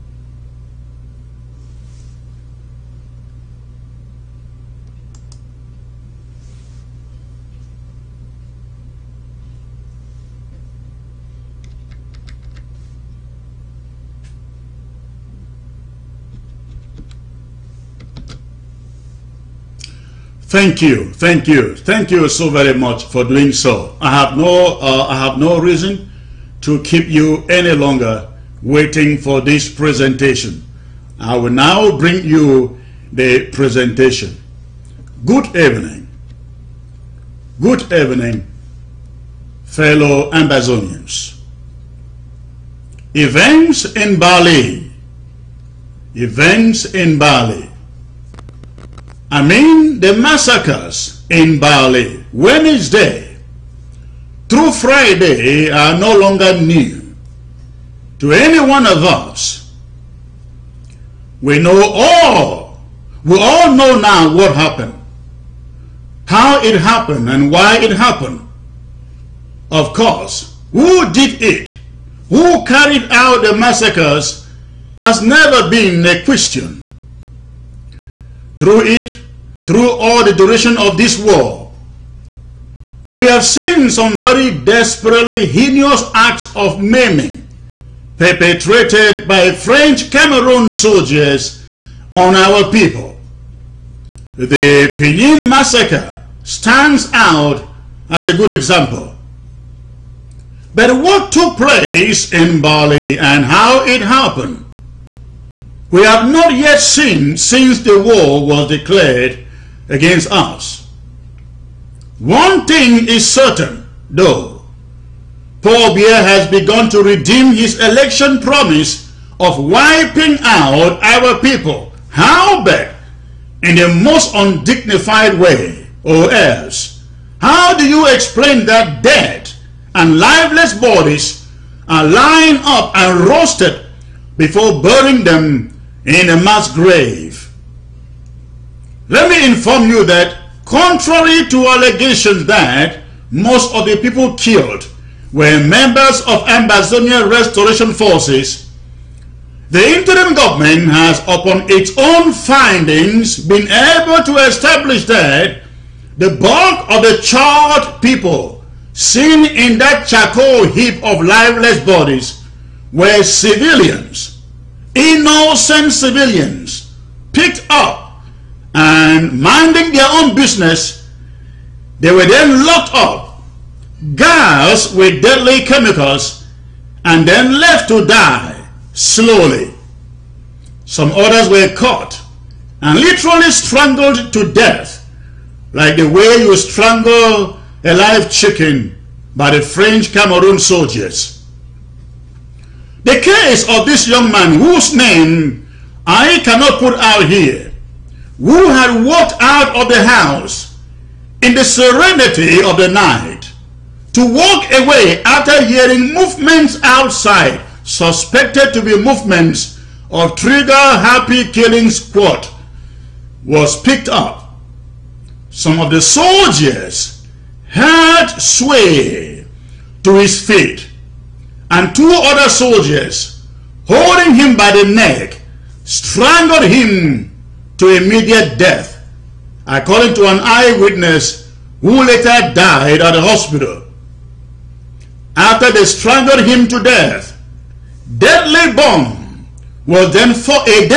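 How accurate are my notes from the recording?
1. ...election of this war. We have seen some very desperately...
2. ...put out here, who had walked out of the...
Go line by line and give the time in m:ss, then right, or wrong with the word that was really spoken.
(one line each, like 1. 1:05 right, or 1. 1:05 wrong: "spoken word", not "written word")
1. 1:20 wrong: "duration", not "election"
2. 3:16 right.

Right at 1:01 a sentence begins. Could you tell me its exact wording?
We know all, we all know now what happened, how it happened and why it happened.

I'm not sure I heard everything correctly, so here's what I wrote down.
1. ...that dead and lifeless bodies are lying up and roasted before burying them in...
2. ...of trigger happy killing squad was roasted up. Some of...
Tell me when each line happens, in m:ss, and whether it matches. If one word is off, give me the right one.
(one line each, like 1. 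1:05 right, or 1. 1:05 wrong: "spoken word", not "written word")
1. 2:08 right
2. 3:30 wrong: "picked", not "roasted".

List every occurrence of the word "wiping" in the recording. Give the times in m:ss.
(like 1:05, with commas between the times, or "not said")
1:59.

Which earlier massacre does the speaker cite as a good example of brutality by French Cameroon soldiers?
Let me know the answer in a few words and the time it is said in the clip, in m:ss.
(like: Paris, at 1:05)
Pinyin massacre, at 1:34.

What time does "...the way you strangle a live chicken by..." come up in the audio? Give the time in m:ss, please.
3:05.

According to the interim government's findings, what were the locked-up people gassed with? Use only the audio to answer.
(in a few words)
deadly chemicals.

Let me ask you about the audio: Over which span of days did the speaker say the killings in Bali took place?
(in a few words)
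Wednesday through Friday.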